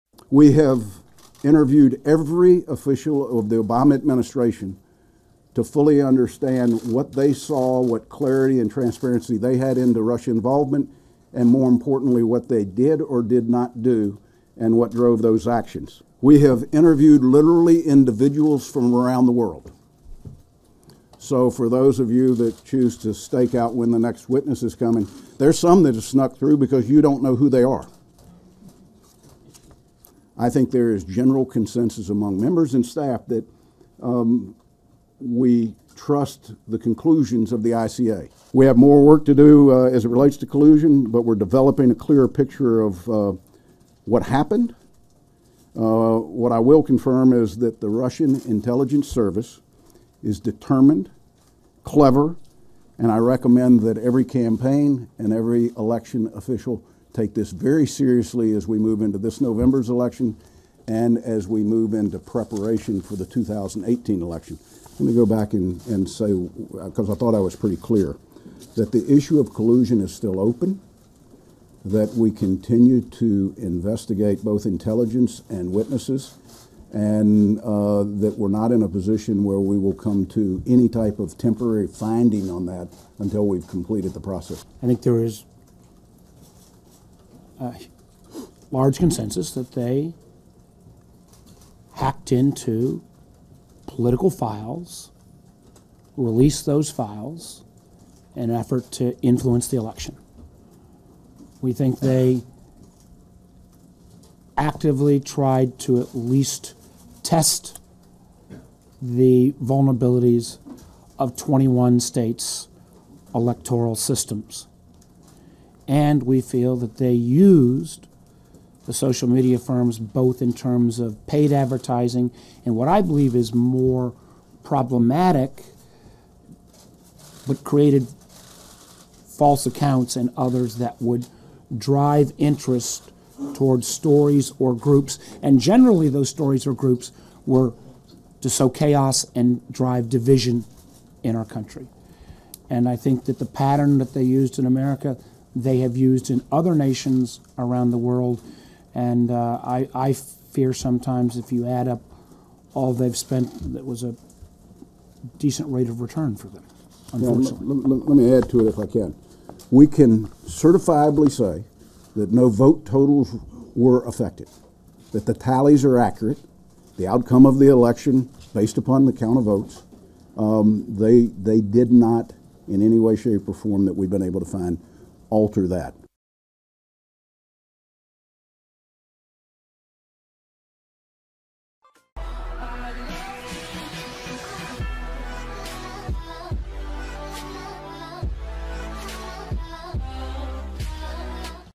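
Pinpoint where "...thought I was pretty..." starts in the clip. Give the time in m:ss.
1:07.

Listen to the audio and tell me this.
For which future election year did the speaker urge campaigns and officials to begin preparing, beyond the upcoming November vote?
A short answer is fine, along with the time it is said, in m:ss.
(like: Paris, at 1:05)
2018, at 1:03.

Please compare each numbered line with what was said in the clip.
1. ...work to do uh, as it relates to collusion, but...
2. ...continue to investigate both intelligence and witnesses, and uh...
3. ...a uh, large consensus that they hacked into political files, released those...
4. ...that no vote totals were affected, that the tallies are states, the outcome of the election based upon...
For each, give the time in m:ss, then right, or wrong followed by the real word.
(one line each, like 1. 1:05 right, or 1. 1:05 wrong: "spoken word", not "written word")
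1. 0:39 right
2. 1:12 right
3. 1:27 right
4. 2:42 wrong: "accurate", not "states".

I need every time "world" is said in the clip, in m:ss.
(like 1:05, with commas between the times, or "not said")
0:19, 2:27.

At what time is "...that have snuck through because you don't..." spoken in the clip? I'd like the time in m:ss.
0:25.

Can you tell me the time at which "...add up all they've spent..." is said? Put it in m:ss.
2:31.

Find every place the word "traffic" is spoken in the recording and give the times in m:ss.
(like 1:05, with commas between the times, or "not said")
not said.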